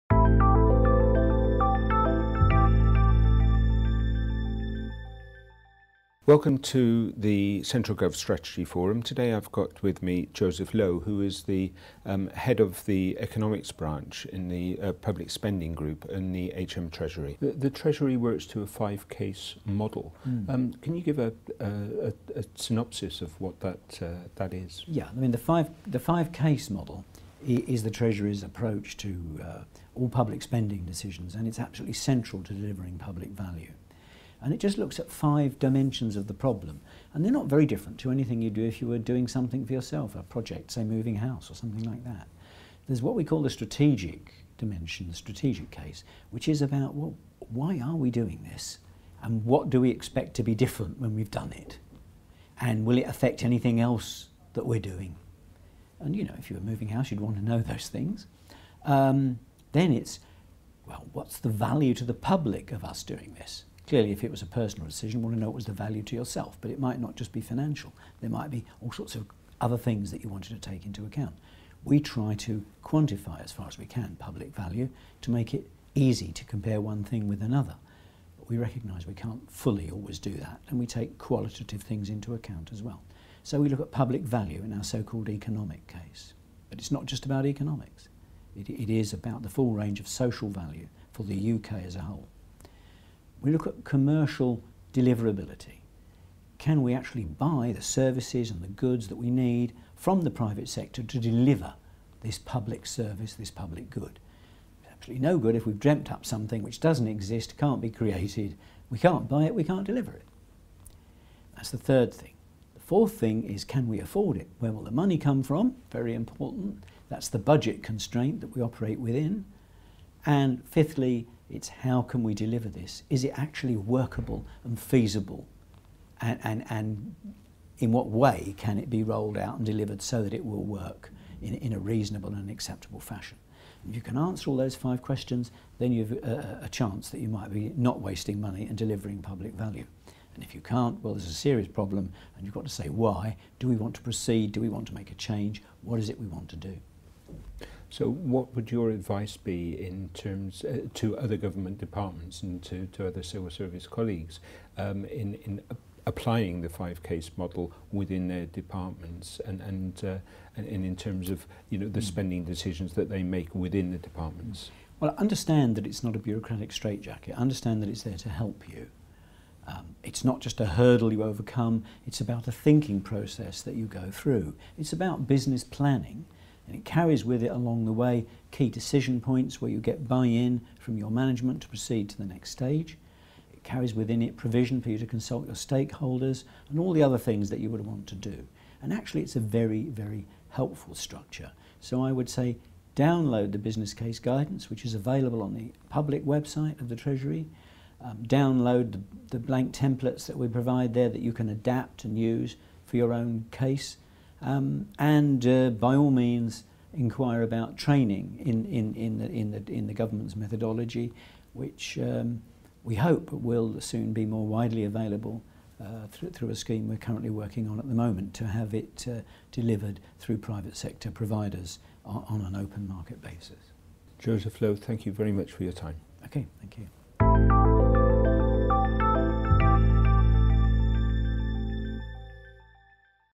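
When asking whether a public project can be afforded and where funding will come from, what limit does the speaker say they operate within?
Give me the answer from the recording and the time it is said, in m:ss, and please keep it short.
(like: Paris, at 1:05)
Budget constraint, at 1:57.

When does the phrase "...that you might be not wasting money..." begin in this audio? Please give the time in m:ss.
2:17.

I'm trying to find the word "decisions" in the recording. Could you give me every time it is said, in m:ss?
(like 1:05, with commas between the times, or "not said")
0:30, 1:04, 2:42, 2:58.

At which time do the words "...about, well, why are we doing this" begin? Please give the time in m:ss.
0:46.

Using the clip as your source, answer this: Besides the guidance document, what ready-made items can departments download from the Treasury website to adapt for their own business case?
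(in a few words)
Blank templates.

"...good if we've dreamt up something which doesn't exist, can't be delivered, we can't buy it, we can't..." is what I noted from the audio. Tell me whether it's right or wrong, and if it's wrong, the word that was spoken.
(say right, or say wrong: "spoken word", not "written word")
wrong: "created", not "delivered".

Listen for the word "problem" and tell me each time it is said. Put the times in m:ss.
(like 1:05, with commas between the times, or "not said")
0:36, 2:21.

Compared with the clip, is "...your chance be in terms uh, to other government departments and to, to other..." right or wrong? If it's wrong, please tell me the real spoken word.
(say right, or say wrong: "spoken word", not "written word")
wrong: "advice", not "chance".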